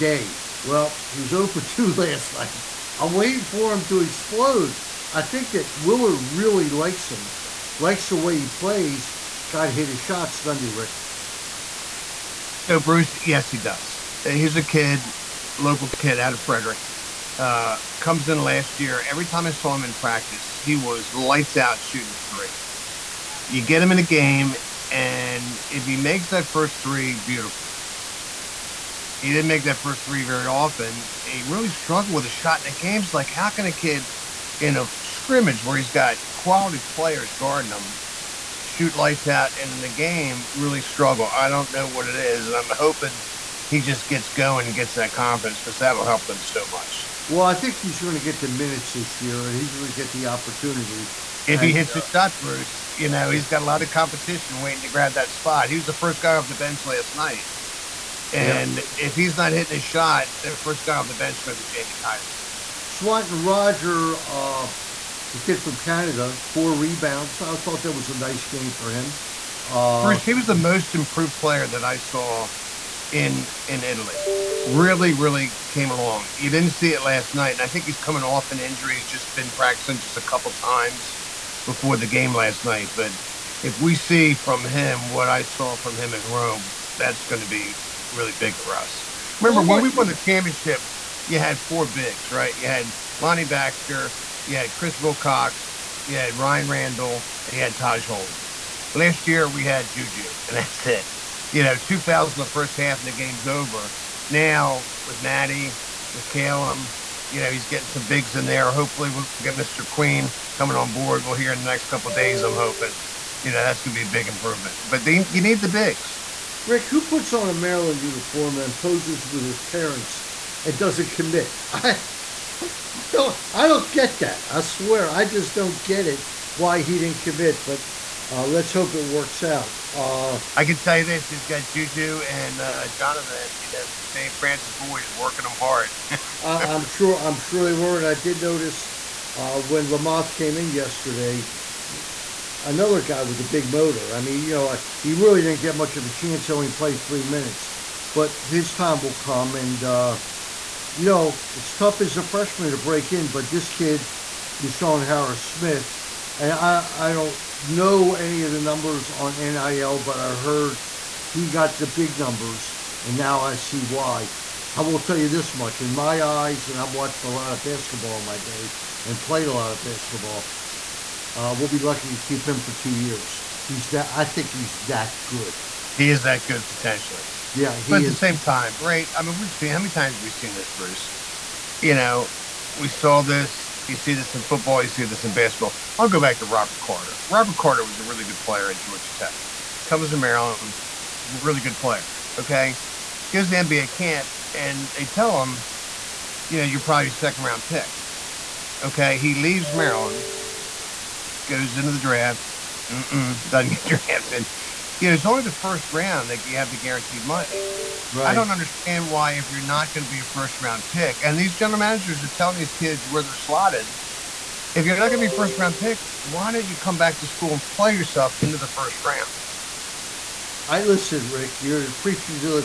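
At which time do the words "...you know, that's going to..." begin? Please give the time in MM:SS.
01:53.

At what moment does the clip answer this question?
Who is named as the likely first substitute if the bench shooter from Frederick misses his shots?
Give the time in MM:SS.
01:01.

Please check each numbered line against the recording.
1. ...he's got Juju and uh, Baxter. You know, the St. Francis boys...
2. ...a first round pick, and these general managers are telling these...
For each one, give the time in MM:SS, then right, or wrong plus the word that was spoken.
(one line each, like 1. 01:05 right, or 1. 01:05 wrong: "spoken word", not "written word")
1. 02:11 wrong: "Jonathan", not "Baxter"
2. 03:30 right.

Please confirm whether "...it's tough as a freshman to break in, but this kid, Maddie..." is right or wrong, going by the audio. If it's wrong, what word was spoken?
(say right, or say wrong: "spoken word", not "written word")
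wrong: "Deshaun", not "Maddie".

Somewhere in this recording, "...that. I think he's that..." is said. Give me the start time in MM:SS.
02:53.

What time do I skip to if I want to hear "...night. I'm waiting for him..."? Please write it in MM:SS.
00:02.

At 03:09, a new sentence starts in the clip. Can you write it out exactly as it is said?
Comes to Maryland, really good player.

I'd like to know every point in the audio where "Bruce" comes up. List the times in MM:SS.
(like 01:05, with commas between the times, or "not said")
00:12, 00:52, 01:10, 03:00.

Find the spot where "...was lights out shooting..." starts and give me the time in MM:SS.
00:20.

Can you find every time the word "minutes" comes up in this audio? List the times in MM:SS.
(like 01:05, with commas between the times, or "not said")
00:48, 02:27.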